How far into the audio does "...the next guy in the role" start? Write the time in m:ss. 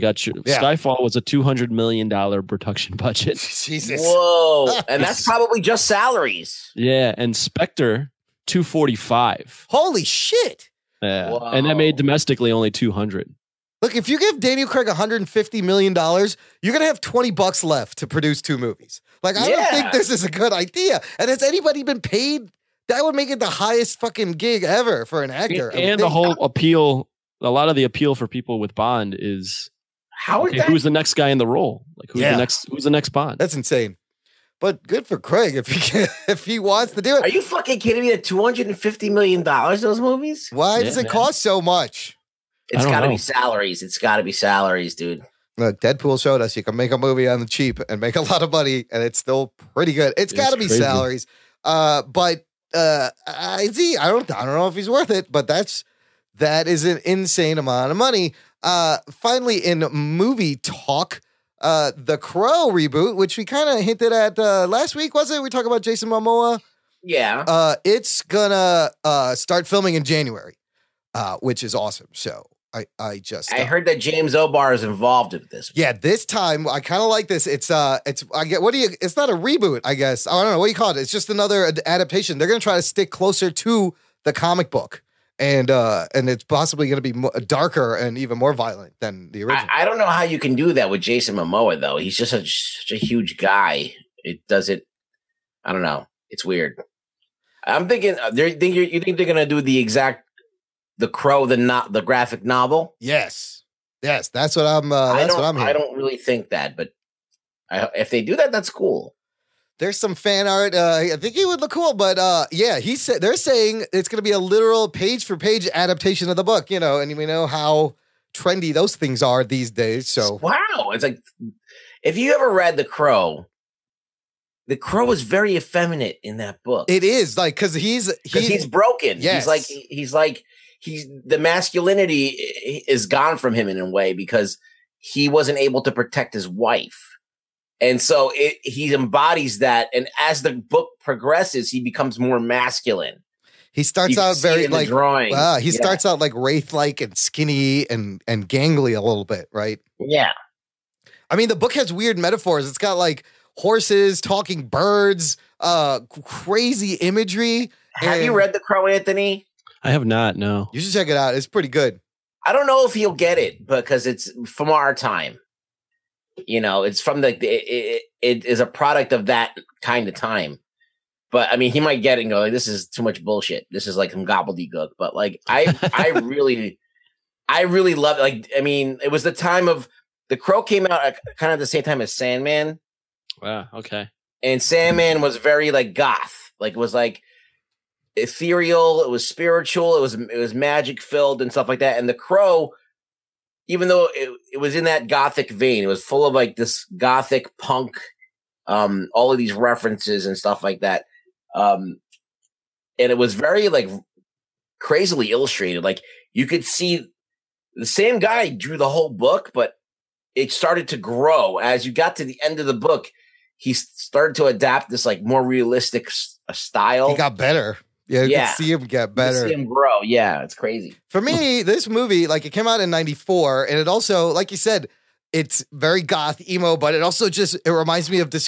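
0:30.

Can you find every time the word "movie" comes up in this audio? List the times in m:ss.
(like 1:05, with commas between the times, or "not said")
0:18, 0:39, 0:46, 0:59, 3:41.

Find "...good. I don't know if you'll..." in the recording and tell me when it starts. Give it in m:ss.
2:41.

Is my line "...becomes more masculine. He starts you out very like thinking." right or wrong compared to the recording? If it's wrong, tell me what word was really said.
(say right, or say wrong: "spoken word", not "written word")
wrong: "drawing", not "thinking".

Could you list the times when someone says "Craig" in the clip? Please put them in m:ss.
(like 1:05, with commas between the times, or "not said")
0:14, 0:35.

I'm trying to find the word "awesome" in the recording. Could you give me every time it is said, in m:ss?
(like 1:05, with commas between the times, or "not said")
1:11.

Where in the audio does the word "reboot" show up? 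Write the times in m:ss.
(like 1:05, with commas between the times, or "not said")
1:02, 1:19.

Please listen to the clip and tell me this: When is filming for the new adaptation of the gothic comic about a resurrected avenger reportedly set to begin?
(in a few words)
January.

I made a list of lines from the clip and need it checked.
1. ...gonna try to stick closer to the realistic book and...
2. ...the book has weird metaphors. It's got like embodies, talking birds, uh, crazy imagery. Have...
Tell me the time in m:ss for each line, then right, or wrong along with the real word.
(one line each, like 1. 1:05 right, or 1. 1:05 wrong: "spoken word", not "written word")
1. 1:22 wrong: "comic", not "realistic"
2. 2:31 wrong: "horses", not "embodies".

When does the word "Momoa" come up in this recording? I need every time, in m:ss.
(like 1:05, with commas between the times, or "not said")
1:06, 1:31.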